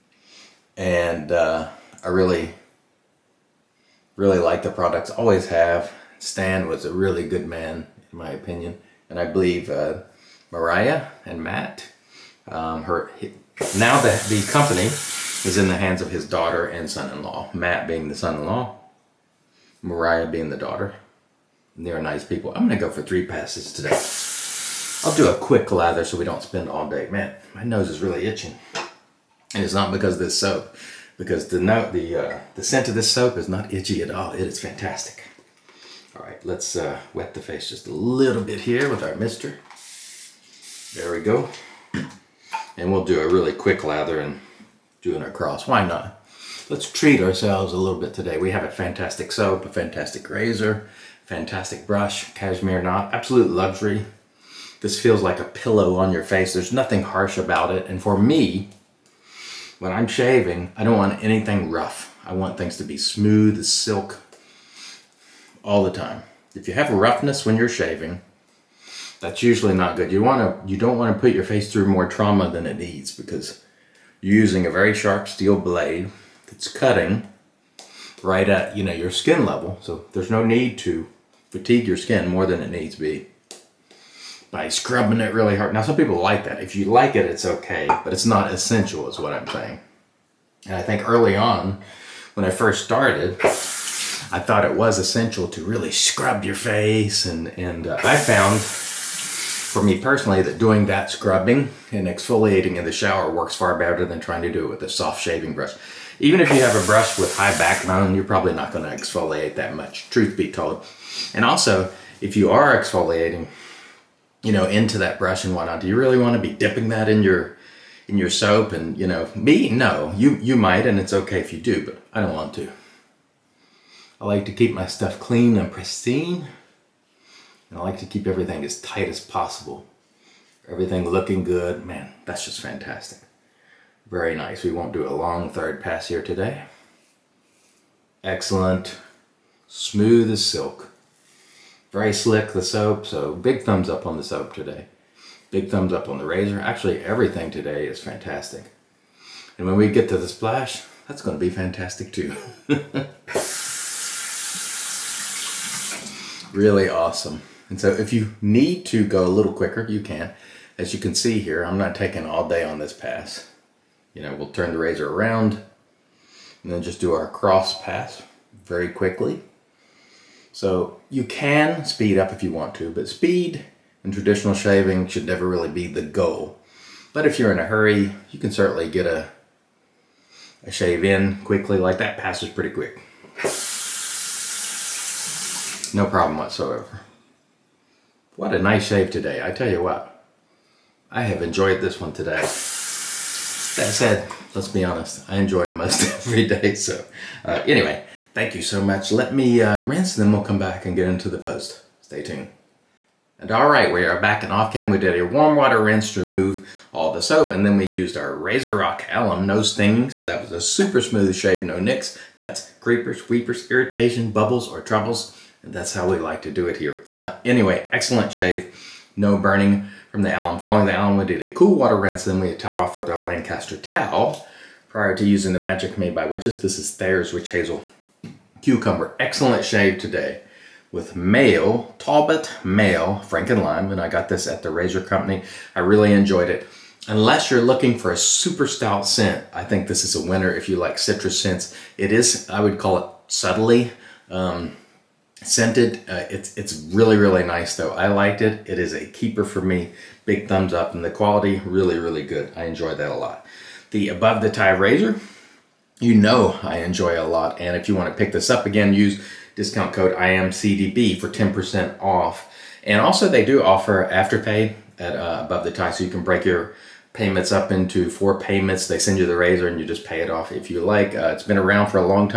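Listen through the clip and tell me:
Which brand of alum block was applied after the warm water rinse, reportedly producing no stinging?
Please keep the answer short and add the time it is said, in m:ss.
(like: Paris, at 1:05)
RazoRock, at 3:28.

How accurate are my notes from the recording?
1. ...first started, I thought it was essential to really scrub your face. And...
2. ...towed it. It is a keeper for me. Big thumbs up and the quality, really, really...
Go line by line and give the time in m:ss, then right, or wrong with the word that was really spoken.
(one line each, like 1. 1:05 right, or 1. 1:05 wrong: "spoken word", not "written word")
1. 1:32 right
2. 4:08 wrong: "liked", not "towed".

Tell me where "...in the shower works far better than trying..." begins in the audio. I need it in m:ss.
1:42.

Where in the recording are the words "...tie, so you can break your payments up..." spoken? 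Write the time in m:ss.
4:25.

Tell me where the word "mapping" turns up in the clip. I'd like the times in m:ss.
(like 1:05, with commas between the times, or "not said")
not said.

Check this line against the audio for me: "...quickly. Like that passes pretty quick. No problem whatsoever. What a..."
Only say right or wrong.
right.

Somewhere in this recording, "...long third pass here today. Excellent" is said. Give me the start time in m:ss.
2:15.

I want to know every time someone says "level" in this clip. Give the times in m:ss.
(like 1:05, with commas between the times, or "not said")
1:19.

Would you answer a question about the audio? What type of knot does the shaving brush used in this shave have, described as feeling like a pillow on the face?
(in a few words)
Cashmere.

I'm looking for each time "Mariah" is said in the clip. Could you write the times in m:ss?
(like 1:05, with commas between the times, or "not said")
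0:10, 0:19.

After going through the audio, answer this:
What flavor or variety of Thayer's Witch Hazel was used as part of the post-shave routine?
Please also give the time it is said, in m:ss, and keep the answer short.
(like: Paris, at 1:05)
Cucumber, at 3:48.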